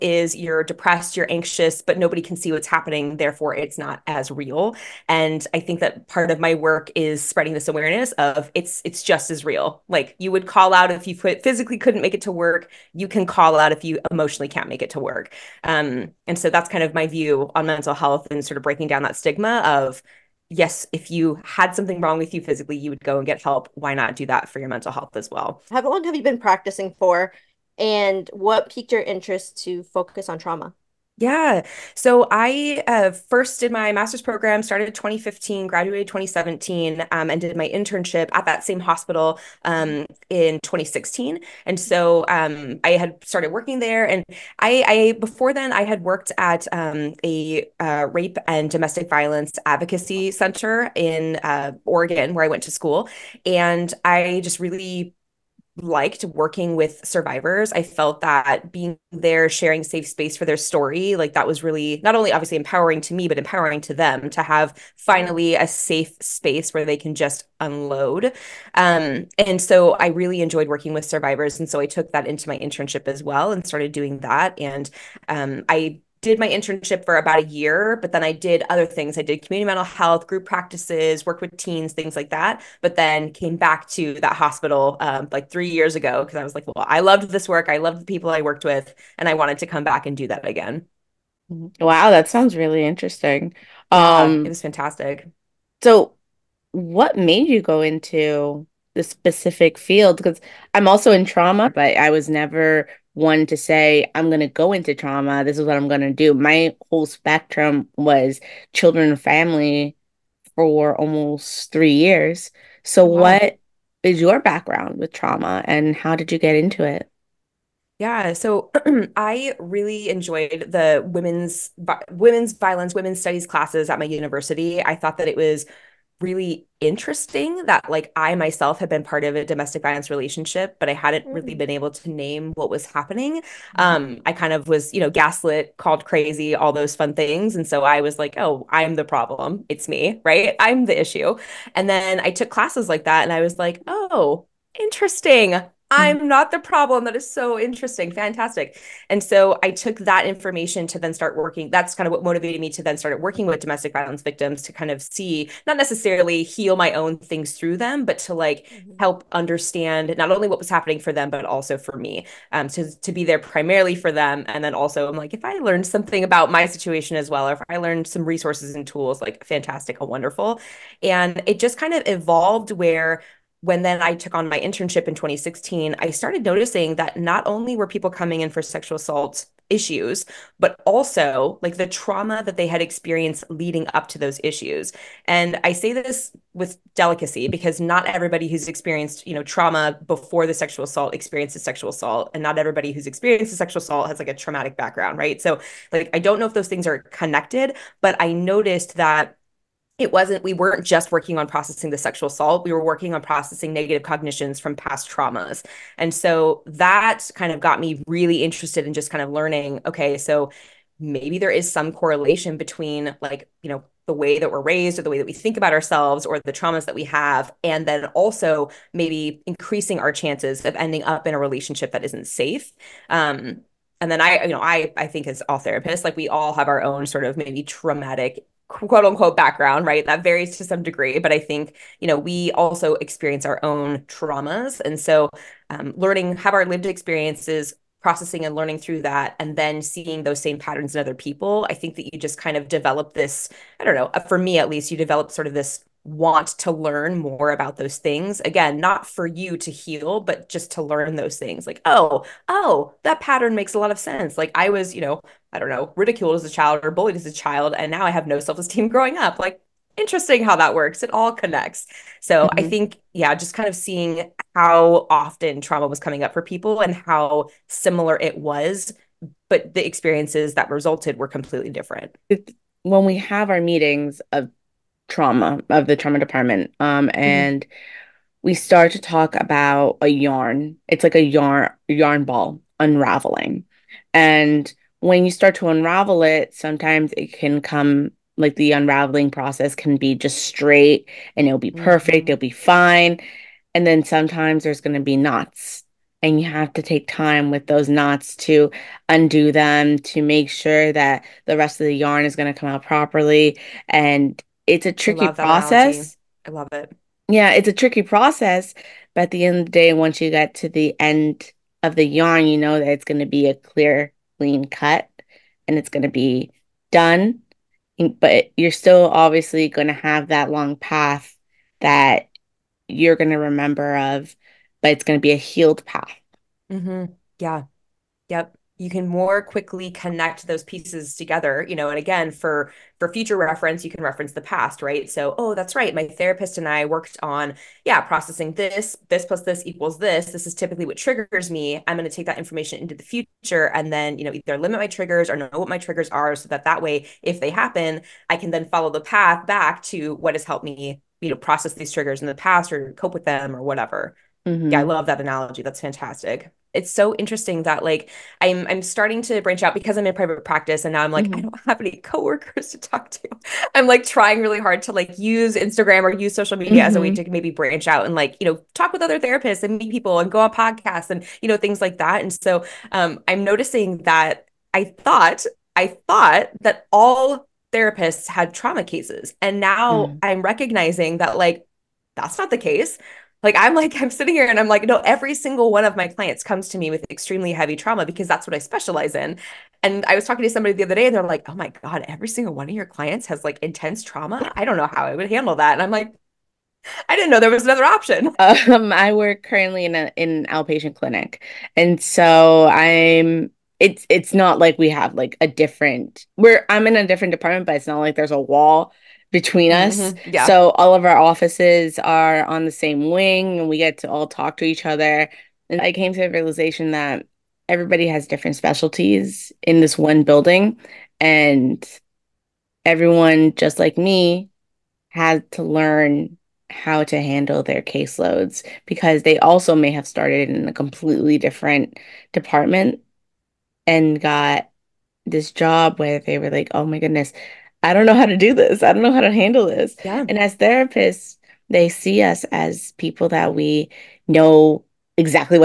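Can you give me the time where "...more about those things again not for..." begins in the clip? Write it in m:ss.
4:07.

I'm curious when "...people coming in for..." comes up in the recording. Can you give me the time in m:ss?
2:57.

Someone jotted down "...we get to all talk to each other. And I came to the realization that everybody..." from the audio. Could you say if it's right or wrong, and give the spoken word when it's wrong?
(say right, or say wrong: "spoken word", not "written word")
right.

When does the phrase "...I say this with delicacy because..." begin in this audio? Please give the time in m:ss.
3:05.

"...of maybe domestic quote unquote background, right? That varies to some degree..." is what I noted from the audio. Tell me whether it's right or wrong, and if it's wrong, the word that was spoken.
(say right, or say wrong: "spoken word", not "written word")
wrong: "traumatic", not "domestic".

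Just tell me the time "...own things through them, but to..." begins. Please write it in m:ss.
2:36.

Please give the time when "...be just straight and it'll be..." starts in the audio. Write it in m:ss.
4:49.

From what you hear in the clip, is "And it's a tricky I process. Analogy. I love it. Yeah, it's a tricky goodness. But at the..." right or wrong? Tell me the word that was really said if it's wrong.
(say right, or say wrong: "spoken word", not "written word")
wrong: "process", not "goodness".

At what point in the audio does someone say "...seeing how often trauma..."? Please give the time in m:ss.
4:23.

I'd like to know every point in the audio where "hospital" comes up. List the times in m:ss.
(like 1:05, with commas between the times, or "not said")
0:38, 1:24.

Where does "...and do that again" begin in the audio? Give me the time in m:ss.
1:30.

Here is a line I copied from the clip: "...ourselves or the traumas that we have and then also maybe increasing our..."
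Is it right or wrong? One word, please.
right.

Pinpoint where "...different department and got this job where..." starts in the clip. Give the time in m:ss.
7:11.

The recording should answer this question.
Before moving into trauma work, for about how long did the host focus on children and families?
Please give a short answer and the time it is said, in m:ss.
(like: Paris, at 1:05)
3 years, at 1:50.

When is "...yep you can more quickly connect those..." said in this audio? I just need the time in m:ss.
5:28.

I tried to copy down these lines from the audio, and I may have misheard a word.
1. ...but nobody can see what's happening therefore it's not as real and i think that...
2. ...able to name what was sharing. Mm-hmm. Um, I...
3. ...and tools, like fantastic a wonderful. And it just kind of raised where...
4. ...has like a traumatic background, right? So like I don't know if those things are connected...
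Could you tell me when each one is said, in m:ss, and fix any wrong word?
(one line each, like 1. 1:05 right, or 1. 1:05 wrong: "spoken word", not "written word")
1. 0:01 right
2. 2:11 wrong: "happening", not "sharing"
3. 2:48 wrong: "evolved", not "raised"
4. 3:14 right.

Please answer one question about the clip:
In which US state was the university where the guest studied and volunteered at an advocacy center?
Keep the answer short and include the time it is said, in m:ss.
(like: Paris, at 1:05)
Oregon, at 0:51.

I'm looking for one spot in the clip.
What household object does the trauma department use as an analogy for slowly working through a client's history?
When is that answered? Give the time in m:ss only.
4:41.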